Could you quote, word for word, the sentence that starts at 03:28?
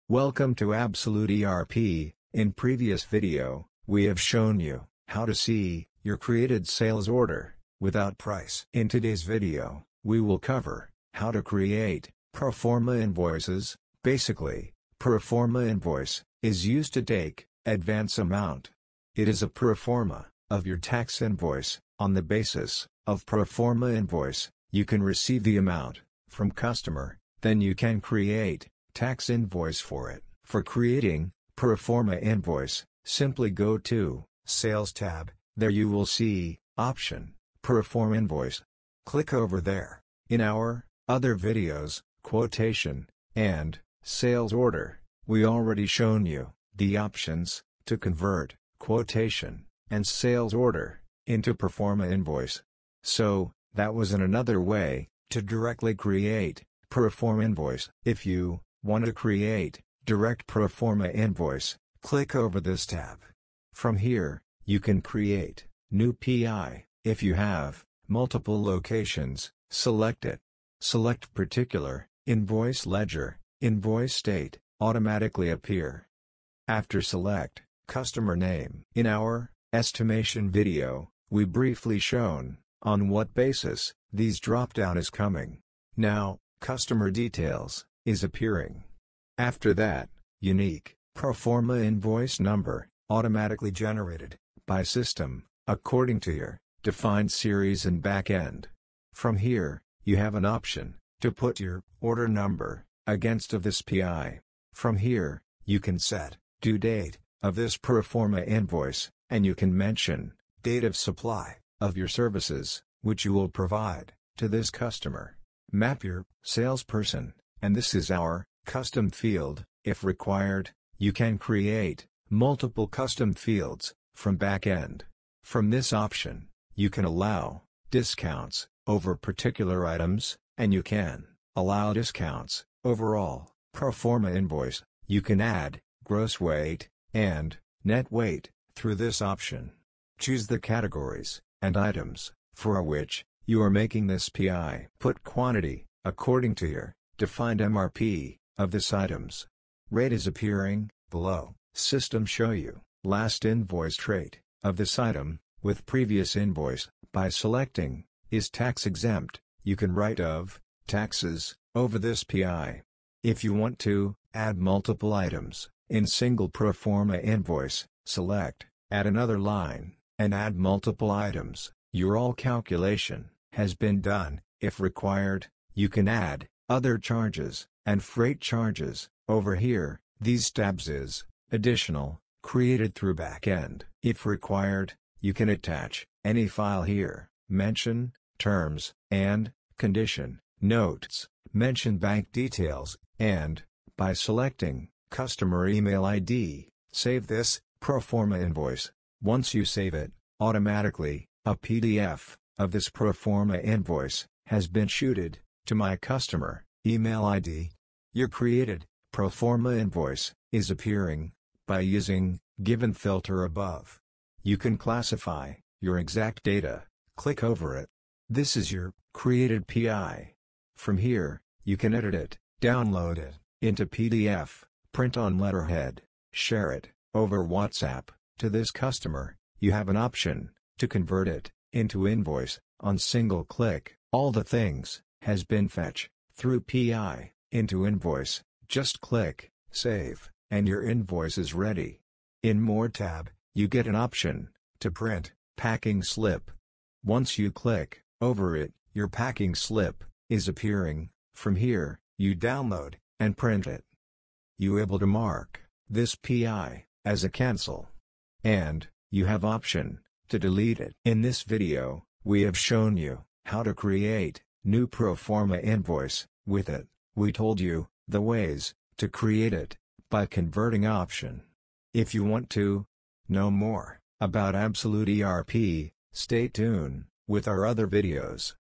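Your created, pro forma invoice, is appearing, by using, given filter above.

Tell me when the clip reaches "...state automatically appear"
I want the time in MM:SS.
01:14.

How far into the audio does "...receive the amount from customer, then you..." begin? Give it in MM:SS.
00:25.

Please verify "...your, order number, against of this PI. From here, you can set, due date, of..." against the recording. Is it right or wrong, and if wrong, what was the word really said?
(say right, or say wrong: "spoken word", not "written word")
right.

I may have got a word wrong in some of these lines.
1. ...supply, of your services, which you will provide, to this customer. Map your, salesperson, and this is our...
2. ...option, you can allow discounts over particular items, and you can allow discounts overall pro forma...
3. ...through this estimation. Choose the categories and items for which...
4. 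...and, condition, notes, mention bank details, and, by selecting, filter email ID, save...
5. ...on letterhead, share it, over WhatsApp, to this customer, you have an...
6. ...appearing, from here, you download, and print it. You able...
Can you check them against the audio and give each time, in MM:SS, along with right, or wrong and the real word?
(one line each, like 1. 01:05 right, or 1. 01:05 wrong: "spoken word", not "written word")
1. 01:50 right
2. 02:05 right
3. 02:18 wrong: "option", not "estimation"
4. 03:09 wrong: "customer", not "filter"
5. 03:45 right
6. 04:10 right.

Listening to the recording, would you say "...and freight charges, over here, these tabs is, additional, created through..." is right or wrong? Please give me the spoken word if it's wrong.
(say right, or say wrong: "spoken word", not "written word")
right.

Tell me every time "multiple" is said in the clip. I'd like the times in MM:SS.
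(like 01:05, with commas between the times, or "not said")
01:08, 02:02, 02:44, 02:50.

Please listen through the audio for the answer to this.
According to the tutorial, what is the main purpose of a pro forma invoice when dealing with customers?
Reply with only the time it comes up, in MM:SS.
00:17.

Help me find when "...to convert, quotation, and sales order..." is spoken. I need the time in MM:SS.
00:47.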